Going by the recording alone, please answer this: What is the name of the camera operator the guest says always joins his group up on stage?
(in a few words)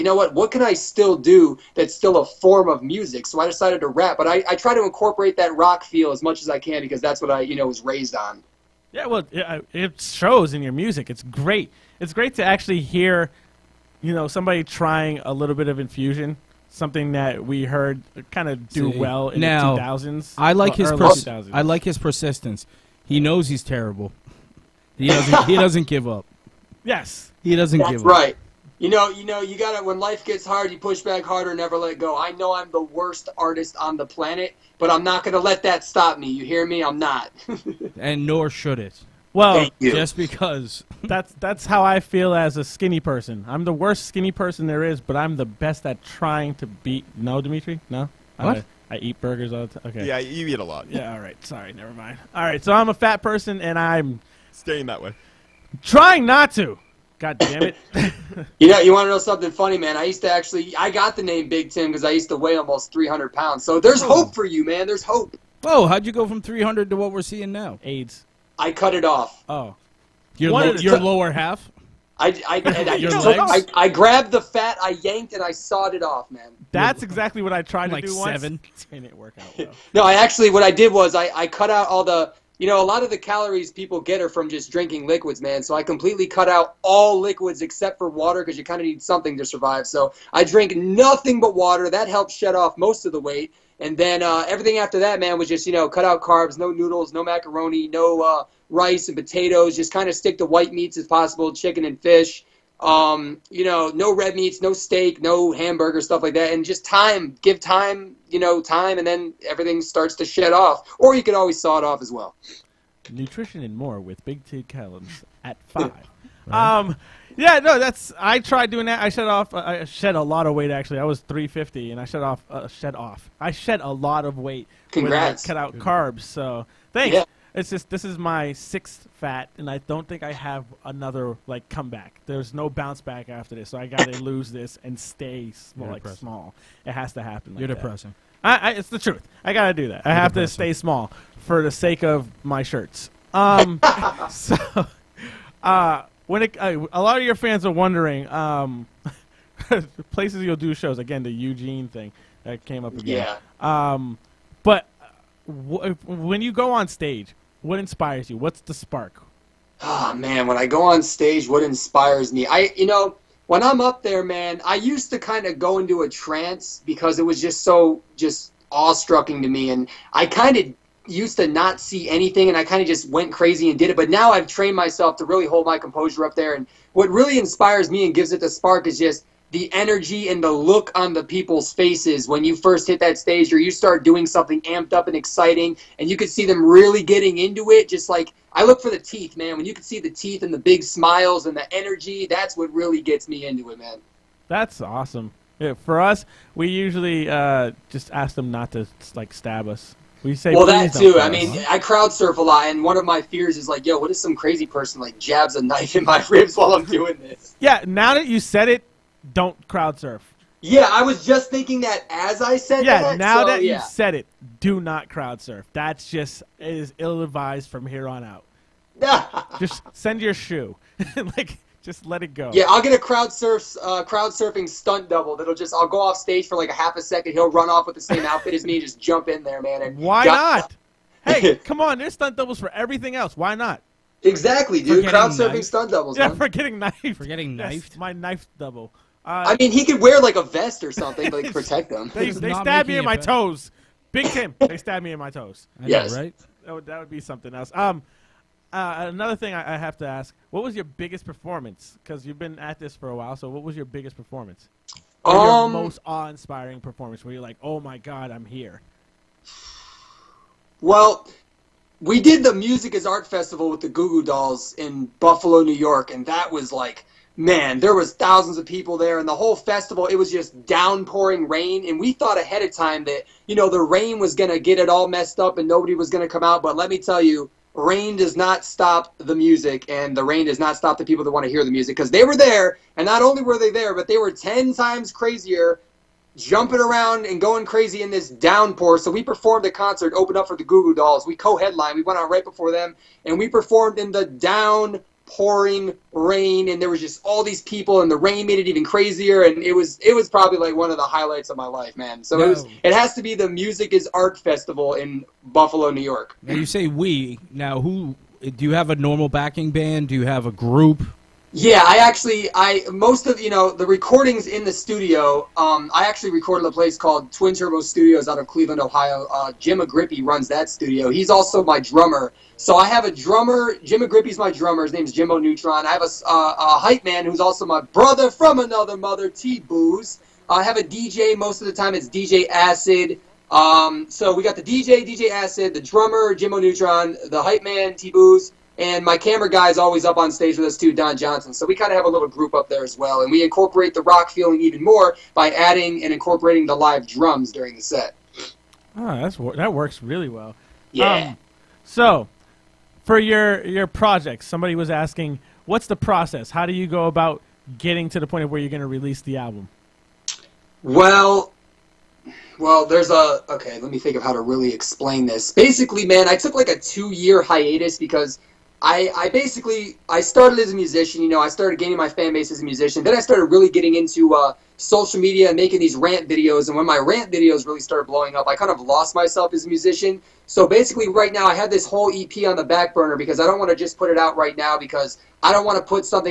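Don Johnson.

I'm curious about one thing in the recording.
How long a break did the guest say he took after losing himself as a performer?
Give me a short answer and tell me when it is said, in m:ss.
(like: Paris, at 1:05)
2 years, at 6:06.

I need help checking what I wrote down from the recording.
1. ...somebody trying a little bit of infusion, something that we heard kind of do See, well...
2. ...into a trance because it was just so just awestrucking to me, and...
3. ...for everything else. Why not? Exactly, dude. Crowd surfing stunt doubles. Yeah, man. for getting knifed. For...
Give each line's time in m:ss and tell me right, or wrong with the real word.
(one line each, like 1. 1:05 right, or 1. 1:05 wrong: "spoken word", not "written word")
1. 0:14 right
2. 2:45 right
3. 3:52 right.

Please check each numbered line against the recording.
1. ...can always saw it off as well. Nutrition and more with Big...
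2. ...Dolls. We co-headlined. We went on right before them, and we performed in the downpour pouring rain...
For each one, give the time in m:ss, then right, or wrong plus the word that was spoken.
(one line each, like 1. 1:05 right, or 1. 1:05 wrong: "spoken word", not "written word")
1. 1:51 right
2. 4:50 right.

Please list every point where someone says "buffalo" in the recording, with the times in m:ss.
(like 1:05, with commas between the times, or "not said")
4:25, 5:05.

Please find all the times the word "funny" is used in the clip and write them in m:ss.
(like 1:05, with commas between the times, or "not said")
0:59.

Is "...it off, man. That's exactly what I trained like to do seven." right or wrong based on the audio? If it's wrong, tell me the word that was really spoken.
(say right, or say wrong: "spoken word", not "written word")
wrong: "tried", not "trained".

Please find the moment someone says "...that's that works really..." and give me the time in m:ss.
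5:49.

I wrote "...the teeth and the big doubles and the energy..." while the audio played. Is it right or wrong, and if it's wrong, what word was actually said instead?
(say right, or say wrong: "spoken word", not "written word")
wrong: "smiles", not "doubles".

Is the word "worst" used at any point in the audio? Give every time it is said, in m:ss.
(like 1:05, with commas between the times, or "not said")
0:32, 0:43.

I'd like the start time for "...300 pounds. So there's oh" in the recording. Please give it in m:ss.
1:02.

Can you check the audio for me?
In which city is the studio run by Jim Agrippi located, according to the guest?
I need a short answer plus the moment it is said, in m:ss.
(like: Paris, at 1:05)
Cleveland, at 5:18.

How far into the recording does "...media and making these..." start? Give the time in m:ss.
6:15.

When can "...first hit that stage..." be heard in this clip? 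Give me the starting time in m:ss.
3:02.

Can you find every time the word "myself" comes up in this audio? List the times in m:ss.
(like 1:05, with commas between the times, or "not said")
2:54, 6:19.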